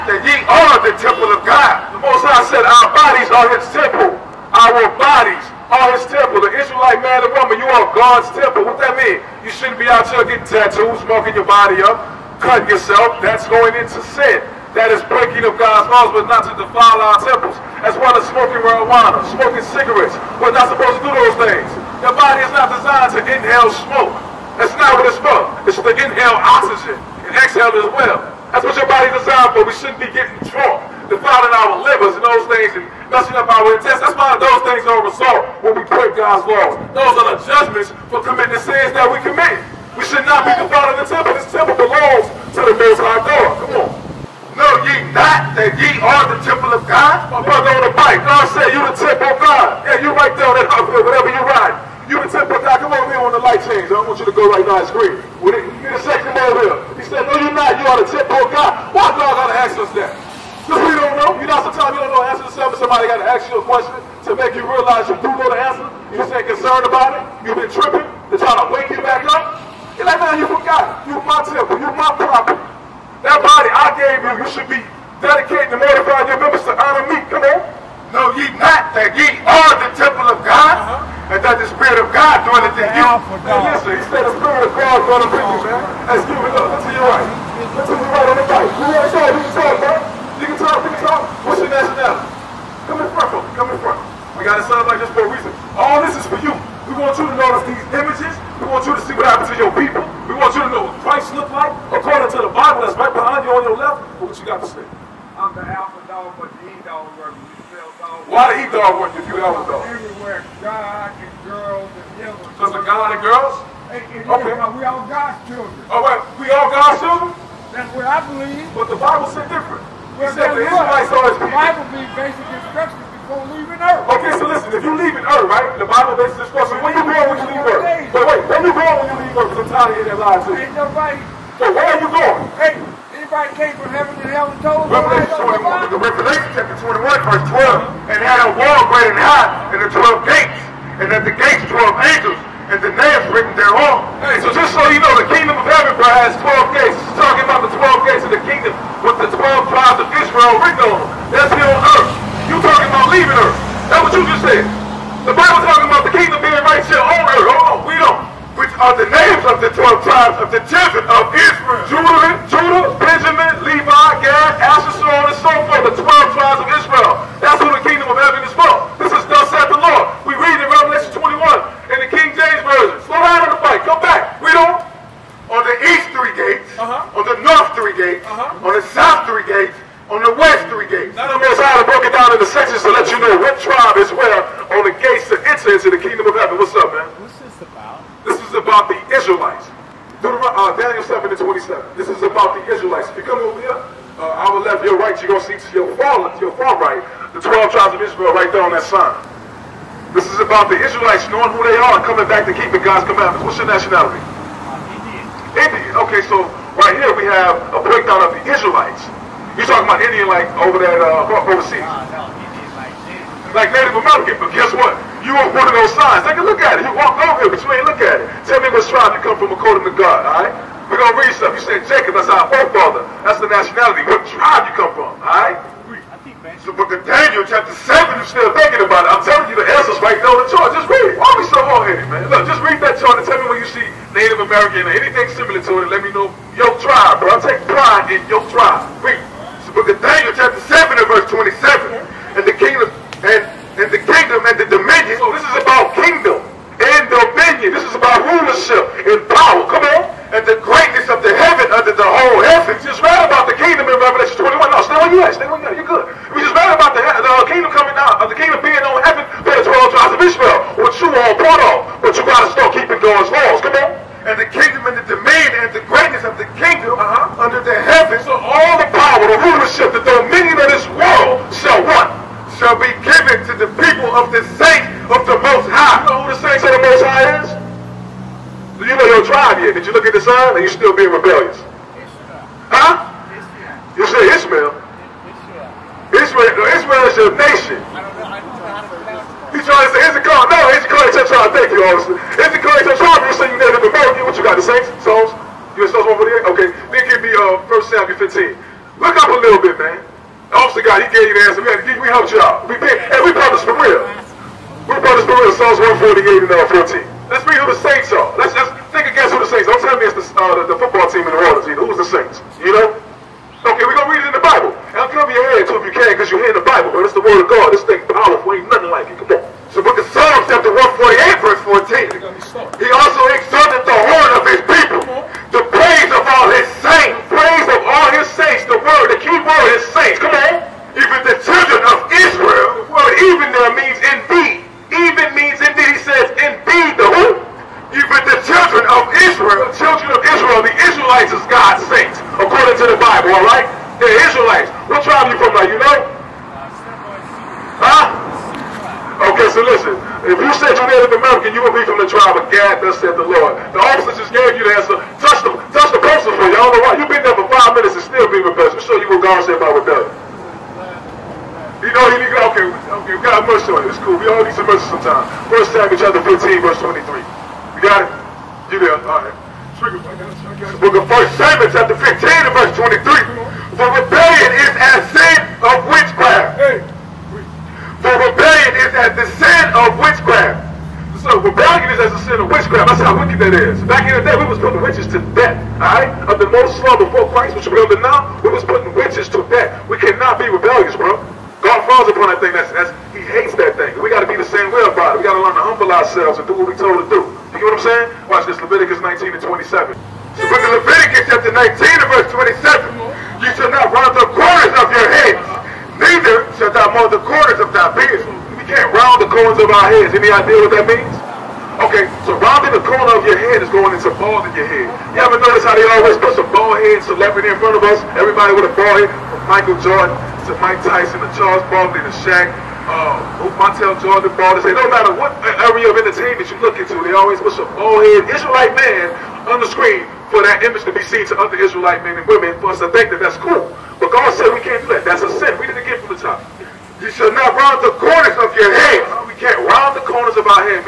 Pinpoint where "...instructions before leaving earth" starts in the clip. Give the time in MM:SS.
02:02.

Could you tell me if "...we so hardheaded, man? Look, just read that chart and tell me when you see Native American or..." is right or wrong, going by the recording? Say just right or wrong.
right.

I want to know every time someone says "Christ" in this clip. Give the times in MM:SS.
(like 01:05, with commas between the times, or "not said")
01:41, 06:27.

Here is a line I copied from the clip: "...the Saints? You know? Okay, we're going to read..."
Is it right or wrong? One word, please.
right.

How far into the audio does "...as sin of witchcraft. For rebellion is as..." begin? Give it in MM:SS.
06:14.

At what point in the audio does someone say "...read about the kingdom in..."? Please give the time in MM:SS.
04:13.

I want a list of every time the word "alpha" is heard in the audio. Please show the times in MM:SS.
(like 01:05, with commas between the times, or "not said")
01:23, 01:45.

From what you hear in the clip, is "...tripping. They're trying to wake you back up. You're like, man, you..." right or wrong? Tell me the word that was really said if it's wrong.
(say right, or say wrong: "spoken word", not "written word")
right.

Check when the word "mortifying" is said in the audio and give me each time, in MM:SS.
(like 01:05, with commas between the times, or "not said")
01:15.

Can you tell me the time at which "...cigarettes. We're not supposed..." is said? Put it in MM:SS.
00:19.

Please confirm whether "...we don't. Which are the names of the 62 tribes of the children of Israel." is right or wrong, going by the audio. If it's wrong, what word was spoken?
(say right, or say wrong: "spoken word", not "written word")
wrong: "12", not "62".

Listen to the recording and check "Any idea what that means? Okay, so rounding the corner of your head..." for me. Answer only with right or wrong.
right.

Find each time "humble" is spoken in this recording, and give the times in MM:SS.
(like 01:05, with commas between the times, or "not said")
06:35.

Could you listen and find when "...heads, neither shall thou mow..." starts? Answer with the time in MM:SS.
06:45.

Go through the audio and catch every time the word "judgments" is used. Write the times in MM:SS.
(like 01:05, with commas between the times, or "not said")
00:37.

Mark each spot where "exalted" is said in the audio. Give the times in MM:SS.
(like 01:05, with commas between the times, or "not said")
05:23.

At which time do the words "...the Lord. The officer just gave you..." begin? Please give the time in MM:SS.
05:53.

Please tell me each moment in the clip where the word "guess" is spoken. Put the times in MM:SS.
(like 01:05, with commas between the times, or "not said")
03:34, 05:09.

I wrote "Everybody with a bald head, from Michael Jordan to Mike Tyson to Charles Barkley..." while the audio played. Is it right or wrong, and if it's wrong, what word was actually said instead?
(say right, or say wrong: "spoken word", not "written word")
right.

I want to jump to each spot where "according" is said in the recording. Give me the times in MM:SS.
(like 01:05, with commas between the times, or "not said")
01:41, 03:39, 05:42.